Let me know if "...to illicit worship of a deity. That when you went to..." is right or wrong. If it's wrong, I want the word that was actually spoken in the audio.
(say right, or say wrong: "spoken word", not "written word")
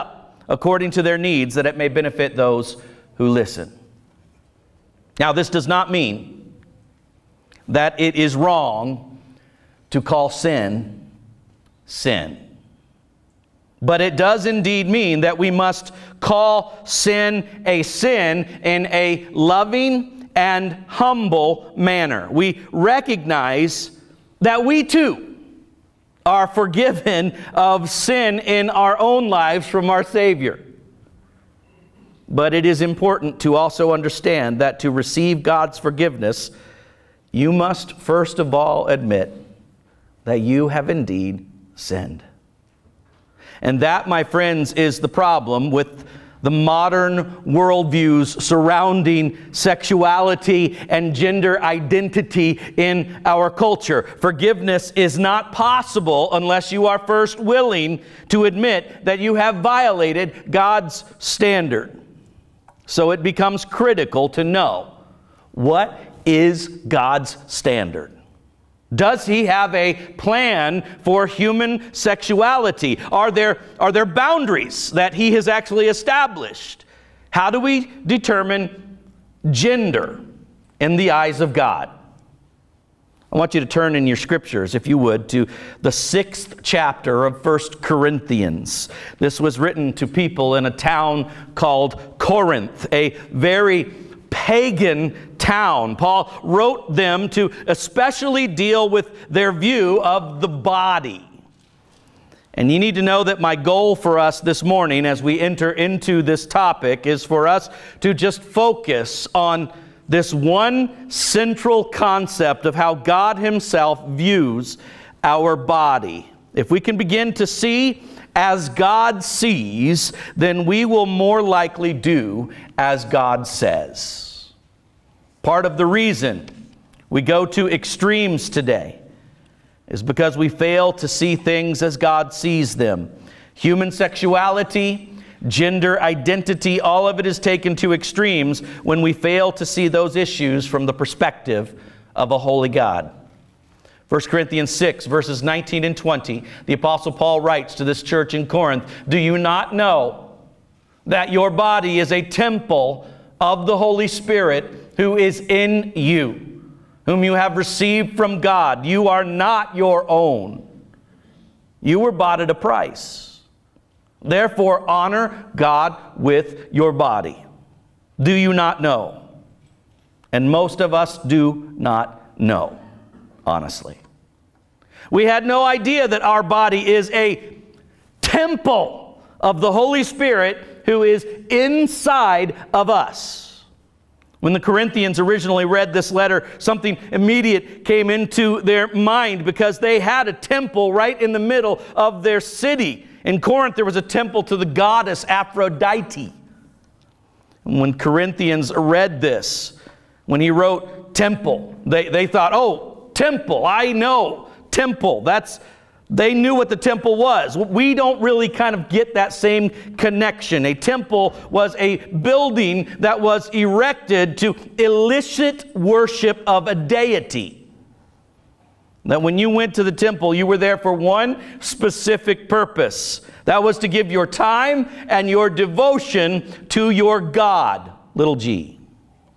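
right.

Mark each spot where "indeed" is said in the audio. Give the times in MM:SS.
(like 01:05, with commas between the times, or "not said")
00:14, 00:40.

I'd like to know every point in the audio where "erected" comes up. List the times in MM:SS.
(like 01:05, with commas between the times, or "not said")
03:33.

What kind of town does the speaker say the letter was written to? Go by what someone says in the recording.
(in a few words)
Pagan.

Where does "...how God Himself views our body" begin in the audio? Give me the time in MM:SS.
01:52.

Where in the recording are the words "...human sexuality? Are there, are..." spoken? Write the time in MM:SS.
01:11.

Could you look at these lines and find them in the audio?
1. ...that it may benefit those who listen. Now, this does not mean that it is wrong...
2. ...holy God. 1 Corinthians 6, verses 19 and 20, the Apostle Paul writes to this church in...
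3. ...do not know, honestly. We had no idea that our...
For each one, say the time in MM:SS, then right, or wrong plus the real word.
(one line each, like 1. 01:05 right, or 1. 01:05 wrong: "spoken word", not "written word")
1. 00:01 right
2. 02:22 right
3. 02:51 right.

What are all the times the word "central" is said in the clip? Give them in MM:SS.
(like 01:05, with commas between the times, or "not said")
01:51.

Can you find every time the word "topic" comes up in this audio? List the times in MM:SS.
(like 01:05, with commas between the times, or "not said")
01:46.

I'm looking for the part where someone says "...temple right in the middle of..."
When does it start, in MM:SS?
03:10.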